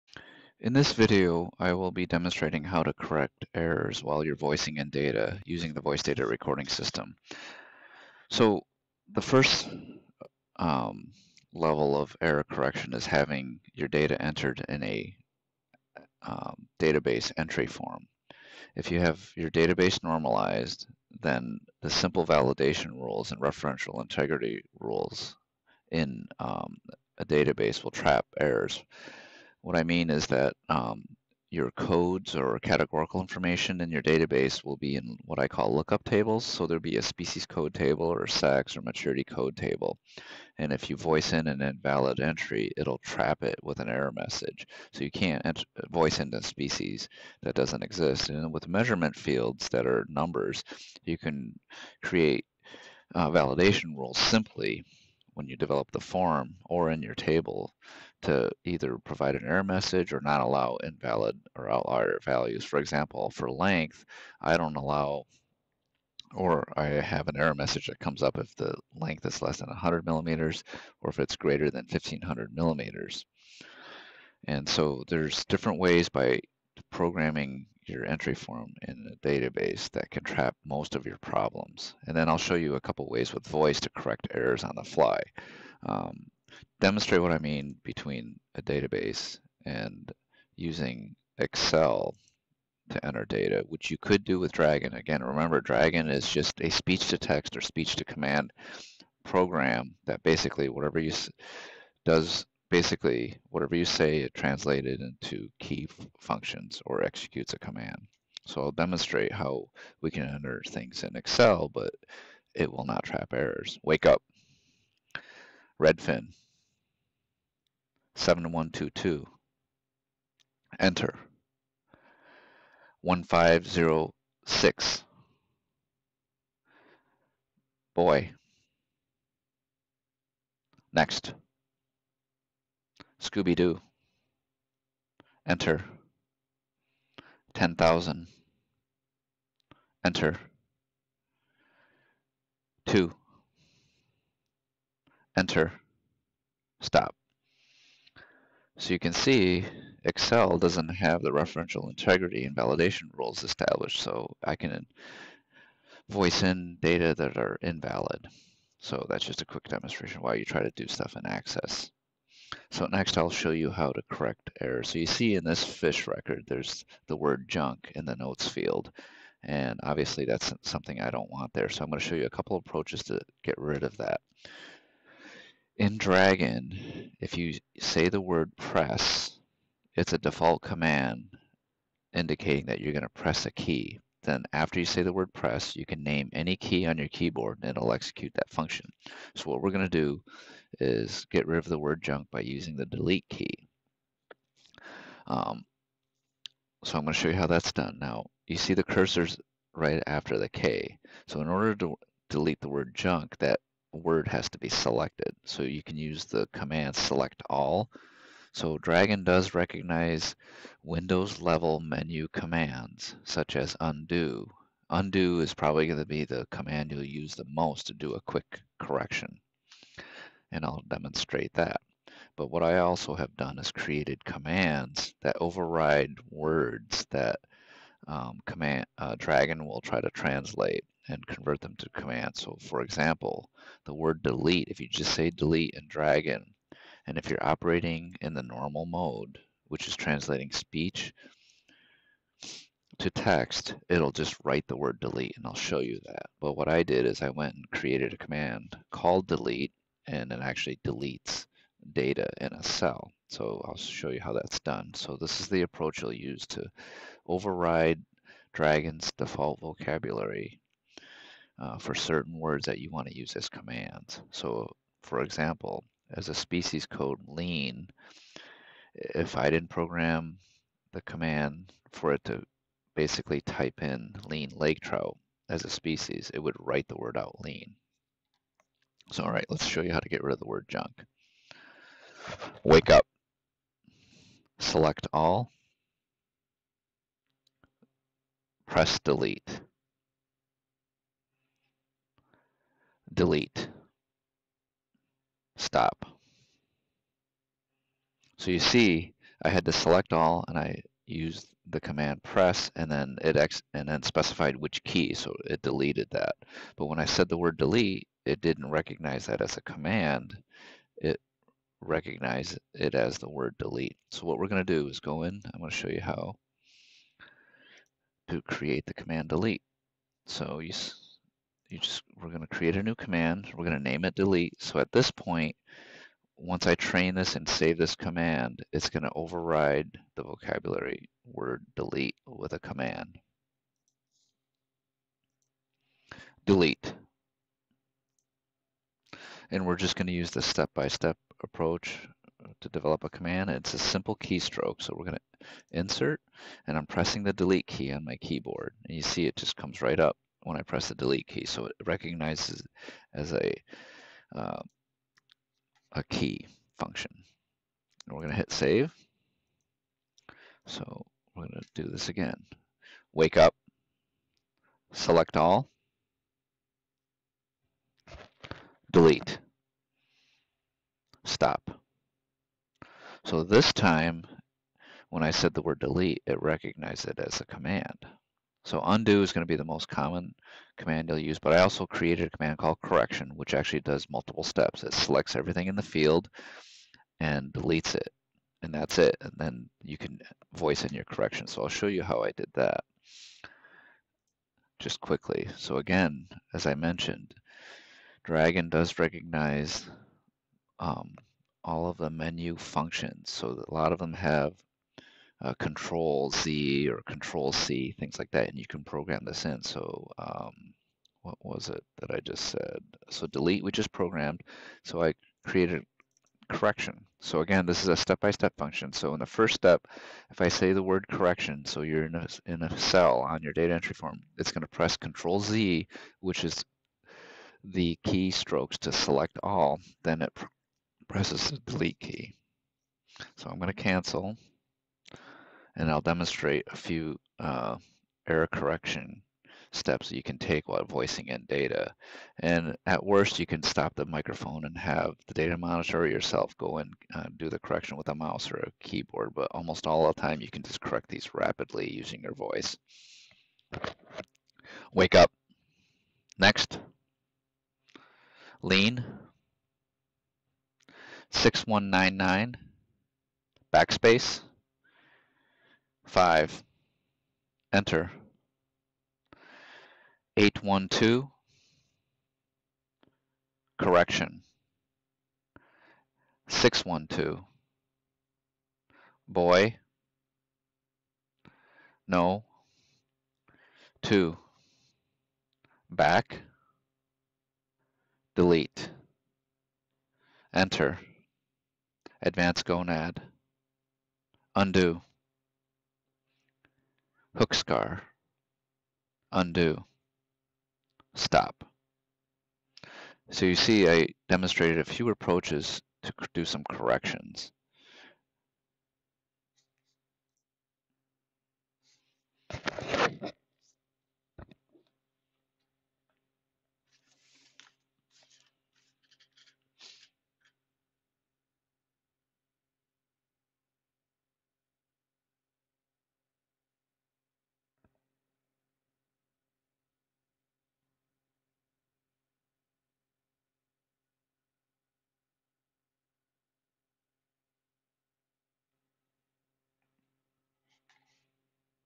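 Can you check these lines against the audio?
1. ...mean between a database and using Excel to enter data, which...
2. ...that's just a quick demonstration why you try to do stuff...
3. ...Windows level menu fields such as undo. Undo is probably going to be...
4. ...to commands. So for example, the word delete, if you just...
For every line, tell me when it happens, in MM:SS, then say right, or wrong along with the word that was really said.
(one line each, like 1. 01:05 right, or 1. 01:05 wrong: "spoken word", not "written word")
1. 01:27 right
2. 02:39 right
3. 03:30 wrong: "commands", not "fields"
4. 03:51 right.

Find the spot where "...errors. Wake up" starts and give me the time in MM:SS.
01:53.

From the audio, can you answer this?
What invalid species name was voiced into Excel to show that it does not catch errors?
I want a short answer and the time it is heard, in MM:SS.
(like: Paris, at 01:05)
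Scooby Doo, at 02:13.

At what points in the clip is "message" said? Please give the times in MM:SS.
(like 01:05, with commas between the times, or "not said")
00:44, 00:59, 01:07.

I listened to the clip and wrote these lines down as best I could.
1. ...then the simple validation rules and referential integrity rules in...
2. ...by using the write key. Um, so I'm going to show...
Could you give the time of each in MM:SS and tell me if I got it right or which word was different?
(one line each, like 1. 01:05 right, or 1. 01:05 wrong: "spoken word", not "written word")
1. 00:21 right
2. 03:12 wrong: "delete", not "write".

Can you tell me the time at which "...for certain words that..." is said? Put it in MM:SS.
04:21.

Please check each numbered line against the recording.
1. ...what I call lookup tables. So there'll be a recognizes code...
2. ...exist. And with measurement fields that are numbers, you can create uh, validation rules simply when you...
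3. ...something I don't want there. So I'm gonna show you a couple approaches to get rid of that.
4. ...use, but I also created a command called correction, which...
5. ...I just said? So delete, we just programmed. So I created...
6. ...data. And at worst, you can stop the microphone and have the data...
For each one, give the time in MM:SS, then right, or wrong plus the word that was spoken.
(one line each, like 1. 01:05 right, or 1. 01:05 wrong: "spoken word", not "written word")
1. 00:35 wrong: "species", not "recognizes"
2. 00:47 right
3. 02:50 right
4. 06:21 right
5. 06:52 right
6. 07:21 right.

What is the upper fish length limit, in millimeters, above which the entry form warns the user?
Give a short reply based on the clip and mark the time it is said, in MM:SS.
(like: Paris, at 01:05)
1500, at 01:11.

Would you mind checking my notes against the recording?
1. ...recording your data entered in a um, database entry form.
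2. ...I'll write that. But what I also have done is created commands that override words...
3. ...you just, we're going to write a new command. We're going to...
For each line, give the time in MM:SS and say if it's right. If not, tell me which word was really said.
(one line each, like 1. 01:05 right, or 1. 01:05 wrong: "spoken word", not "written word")
1. 00:13 wrong: "having", not "recording"
2. 03:40 wrong: "demonstrate", not "write"
3. 05:21 wrong: "create", not "write".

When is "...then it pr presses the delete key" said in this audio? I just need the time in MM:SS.
07:10.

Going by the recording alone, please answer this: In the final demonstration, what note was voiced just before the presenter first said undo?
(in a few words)
Advance gonad.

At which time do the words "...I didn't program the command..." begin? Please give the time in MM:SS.
04:29.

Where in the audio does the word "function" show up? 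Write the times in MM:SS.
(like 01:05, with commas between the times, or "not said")
01:46, 03:08, 05:56, 06:42, 06:58.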